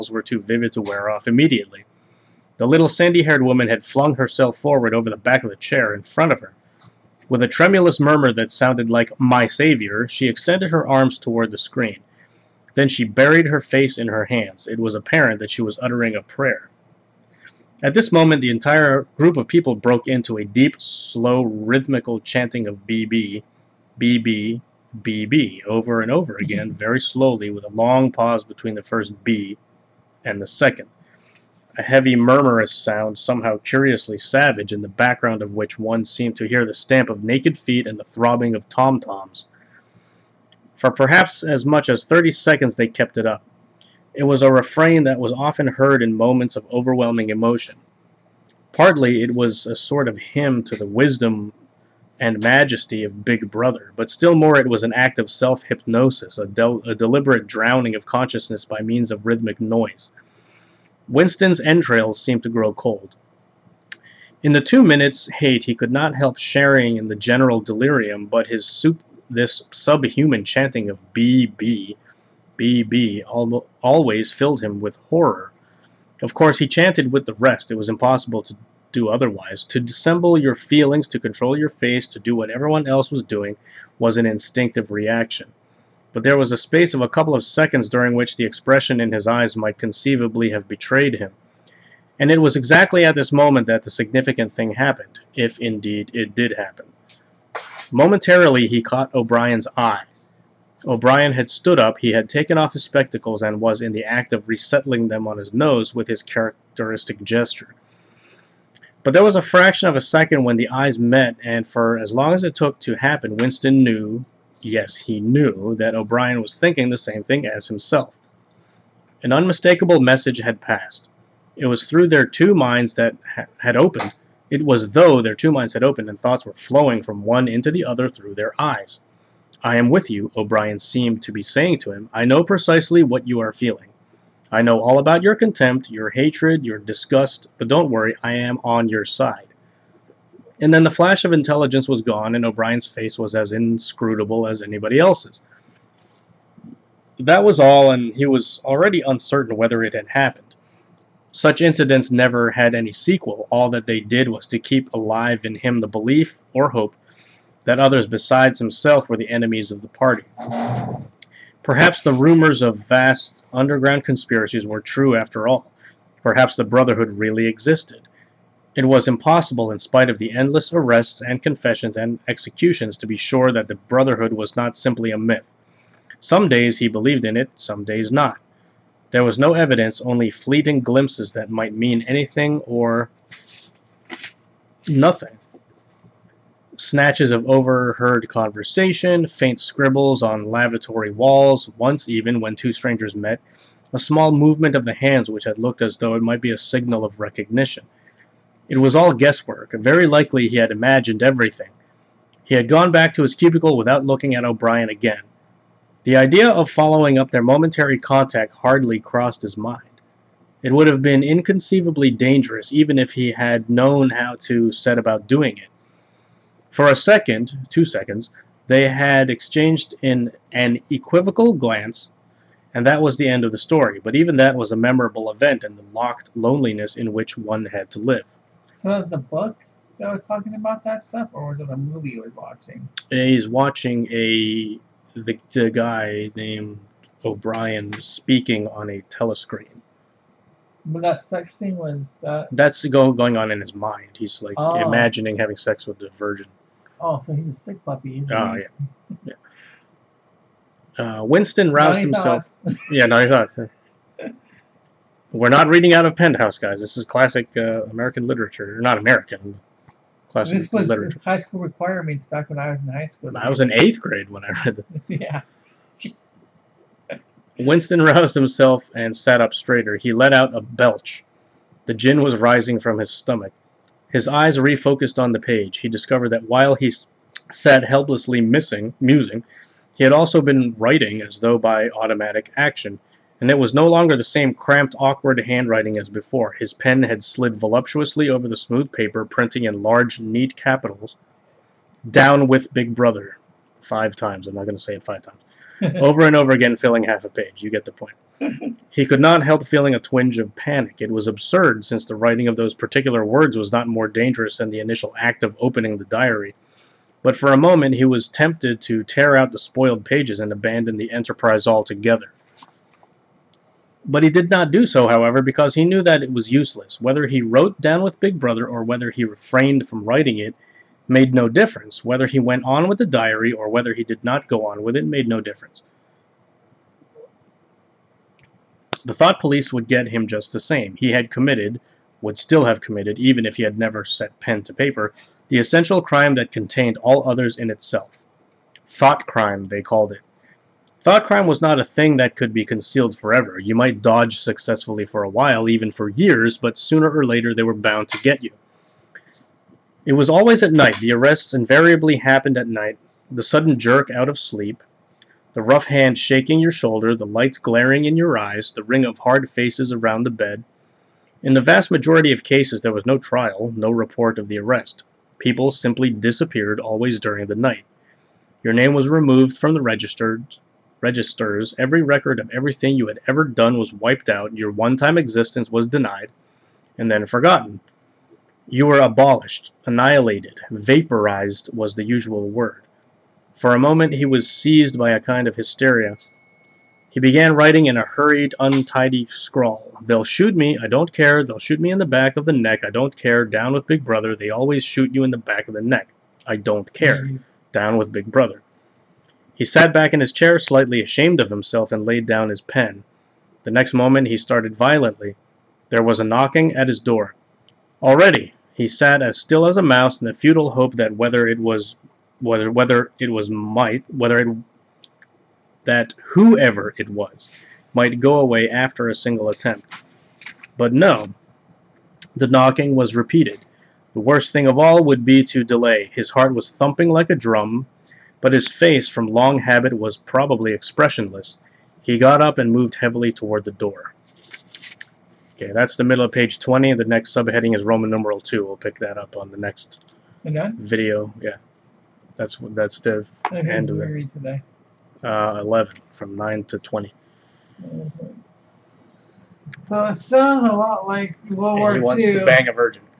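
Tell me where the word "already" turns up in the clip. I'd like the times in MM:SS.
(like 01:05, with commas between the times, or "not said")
02:28, 06:48.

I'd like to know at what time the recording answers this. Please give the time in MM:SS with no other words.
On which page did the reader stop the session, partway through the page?
07:16.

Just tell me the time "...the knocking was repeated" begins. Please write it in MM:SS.
07:02.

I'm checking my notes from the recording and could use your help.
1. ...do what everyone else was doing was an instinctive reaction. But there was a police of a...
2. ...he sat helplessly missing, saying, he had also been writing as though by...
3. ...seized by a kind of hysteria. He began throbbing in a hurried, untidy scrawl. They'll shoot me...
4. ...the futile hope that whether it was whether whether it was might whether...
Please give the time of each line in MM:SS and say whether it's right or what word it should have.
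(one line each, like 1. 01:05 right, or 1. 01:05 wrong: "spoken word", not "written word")
1. 01:22 wrong: "space", not "police"
2. 04:36 wrong: "musing", not "saying"
3. 06:24 wrong: "writing", not "throbbing"
4. 06:50 right.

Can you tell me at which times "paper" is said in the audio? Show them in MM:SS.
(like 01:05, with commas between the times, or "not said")
04:48, 05:34.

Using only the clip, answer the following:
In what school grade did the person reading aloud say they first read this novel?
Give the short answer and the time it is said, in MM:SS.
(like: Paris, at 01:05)
eighth grade, at 04:23.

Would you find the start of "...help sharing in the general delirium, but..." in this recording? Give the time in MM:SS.
01:06.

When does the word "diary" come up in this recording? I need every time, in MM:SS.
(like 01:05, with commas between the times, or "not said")
05:06, 05:23.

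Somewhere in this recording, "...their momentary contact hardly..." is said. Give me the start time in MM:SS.
03:27.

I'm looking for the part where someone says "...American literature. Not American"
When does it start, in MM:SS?
04:17.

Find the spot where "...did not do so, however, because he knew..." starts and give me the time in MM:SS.
05:14.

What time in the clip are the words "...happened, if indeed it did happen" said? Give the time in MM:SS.
01:34.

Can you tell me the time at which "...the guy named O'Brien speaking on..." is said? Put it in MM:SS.
03:55.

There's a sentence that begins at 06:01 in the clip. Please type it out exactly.
In the vast majority of cases, there was no trial, no report of the arrest.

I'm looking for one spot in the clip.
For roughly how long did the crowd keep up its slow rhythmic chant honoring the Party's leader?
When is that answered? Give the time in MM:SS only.
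00:42.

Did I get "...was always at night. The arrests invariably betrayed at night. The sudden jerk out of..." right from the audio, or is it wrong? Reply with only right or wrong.
wrong.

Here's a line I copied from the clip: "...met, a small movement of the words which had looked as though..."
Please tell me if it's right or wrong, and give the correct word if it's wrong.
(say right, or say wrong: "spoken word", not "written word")
wrong: "hands", not "words".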